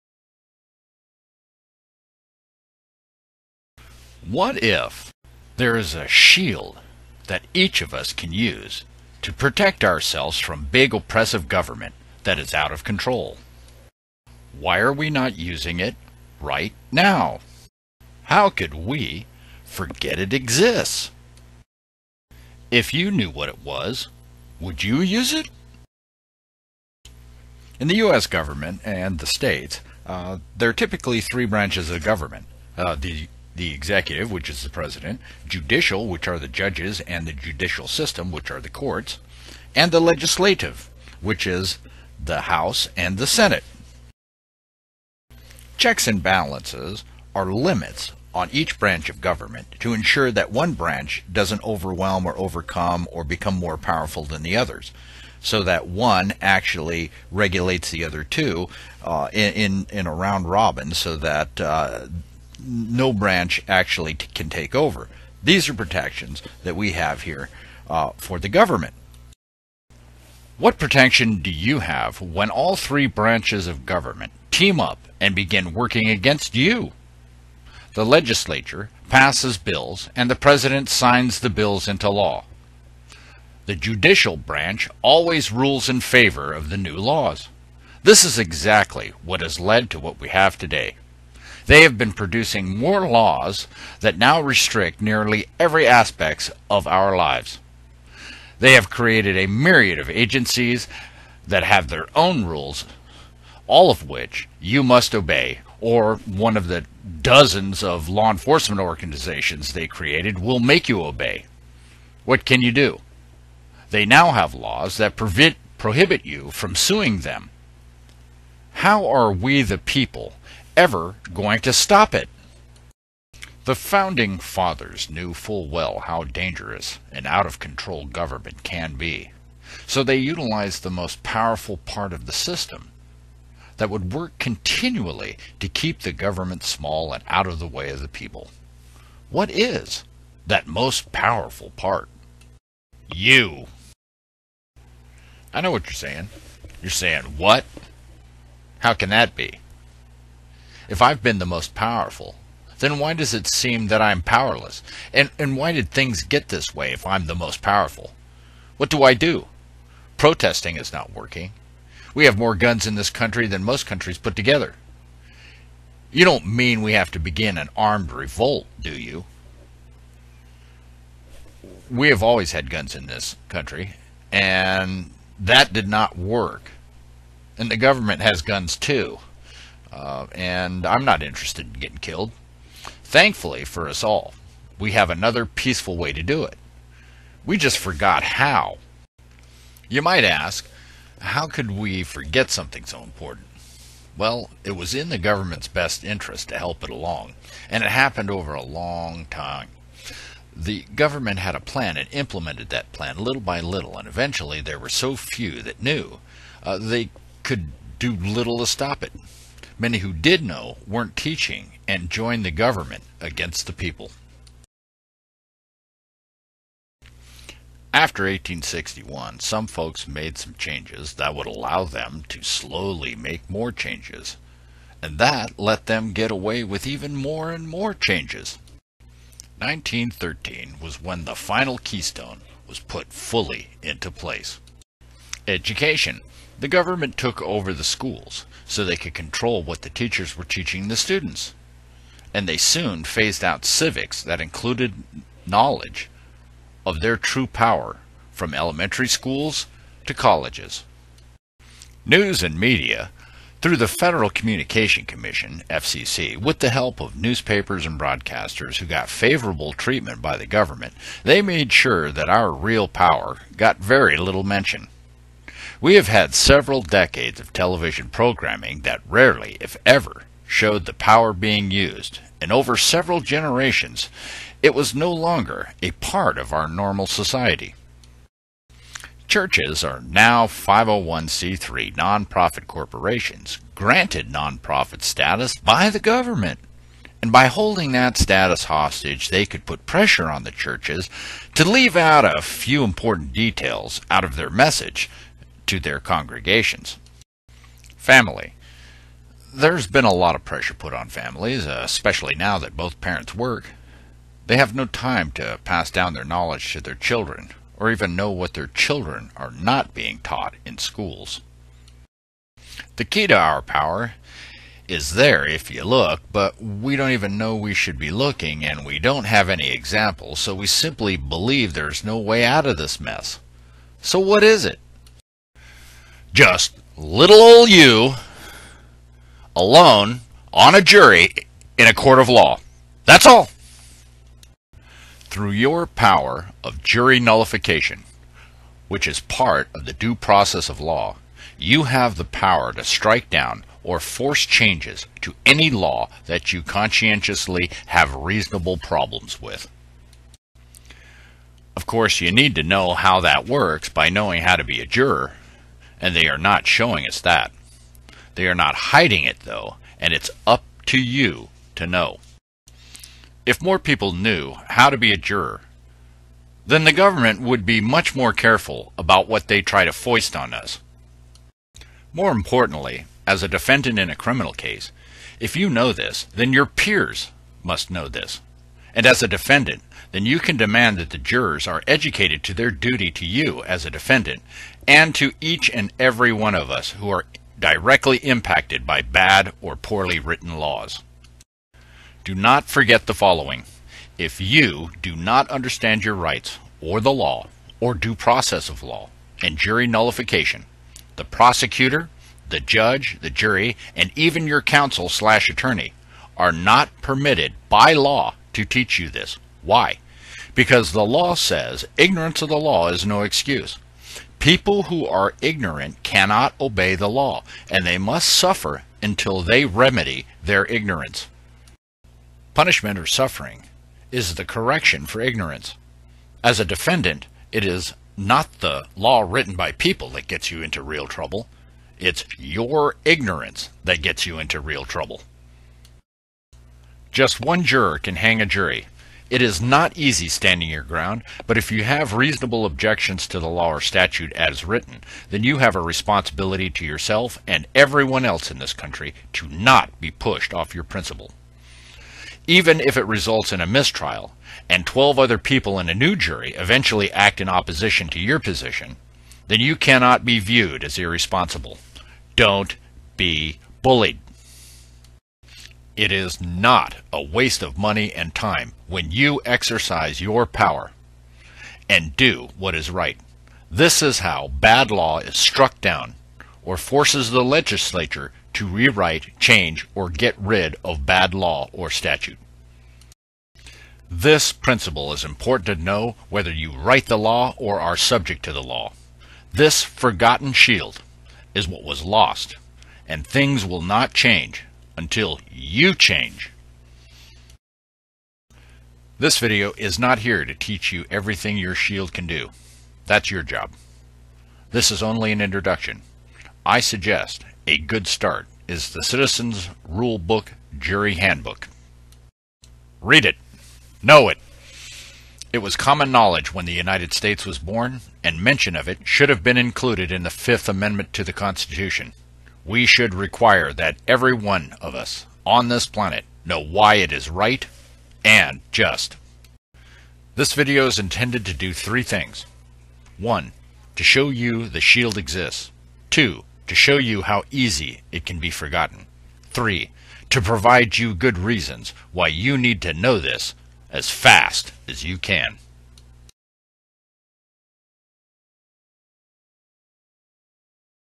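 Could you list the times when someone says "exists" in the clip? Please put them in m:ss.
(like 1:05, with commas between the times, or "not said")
0:20, 8:55.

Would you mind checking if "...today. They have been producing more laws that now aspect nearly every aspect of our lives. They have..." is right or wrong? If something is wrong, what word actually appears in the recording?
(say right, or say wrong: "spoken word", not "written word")
wrong: "restrict", not "aspect".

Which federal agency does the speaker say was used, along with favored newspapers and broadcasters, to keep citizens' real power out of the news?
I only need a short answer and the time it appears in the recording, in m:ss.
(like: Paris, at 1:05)
Federal Communication Commission, at 4:13.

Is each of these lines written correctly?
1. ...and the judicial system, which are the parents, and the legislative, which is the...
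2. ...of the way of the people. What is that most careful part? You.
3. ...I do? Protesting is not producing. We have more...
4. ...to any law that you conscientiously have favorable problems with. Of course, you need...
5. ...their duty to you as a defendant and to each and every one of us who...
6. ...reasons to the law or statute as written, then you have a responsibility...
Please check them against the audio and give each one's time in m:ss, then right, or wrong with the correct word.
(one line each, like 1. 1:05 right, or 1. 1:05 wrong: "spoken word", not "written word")
1. 0:37 wrong: "courts", not "parents"
2. 2:17 wrong: "powerful", not "careful"
3. 2:39 wrong: "working", not "producing"
4. 5:45 wrong: "reasonable", not "favorable"
5. 6:22 right
6. 7:22 wrong: "objections", not "reasons".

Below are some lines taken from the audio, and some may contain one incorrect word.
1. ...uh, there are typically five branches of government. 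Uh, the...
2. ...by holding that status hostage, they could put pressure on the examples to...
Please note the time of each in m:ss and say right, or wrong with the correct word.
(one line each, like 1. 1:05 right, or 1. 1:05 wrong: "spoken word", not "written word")
1. 0:30 wrong: "three", not "five"
2. 4:47 wrong: "churches", not "examples".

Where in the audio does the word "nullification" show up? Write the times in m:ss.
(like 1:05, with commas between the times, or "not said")
5:37, 6:39.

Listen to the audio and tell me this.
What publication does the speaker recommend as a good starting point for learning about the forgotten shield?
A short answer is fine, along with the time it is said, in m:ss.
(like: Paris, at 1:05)
Citizens Rule Book Jury Handbook, at 8:29.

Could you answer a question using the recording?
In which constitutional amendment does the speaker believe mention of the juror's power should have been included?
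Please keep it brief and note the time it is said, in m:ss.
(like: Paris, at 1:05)
Fifth Amendment, at 8:40.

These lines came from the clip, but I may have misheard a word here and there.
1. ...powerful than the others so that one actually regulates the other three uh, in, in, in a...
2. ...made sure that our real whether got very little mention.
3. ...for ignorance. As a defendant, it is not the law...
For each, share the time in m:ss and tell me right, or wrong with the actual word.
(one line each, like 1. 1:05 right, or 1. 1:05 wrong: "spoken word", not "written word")
1. 0:53 wrong: "two", not "three"
2. 4:21 wrong: "power", not "whether"
3. 7:05 right.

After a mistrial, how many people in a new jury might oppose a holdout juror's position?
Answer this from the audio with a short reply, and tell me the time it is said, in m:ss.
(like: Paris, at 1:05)
12, at 7:34.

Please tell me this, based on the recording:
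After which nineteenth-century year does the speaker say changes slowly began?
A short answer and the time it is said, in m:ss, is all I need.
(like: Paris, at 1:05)
1861, at 3:38.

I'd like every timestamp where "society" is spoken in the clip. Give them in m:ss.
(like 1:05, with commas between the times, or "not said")
4:37.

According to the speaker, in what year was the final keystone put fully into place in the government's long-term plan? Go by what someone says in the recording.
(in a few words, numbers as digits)
1913.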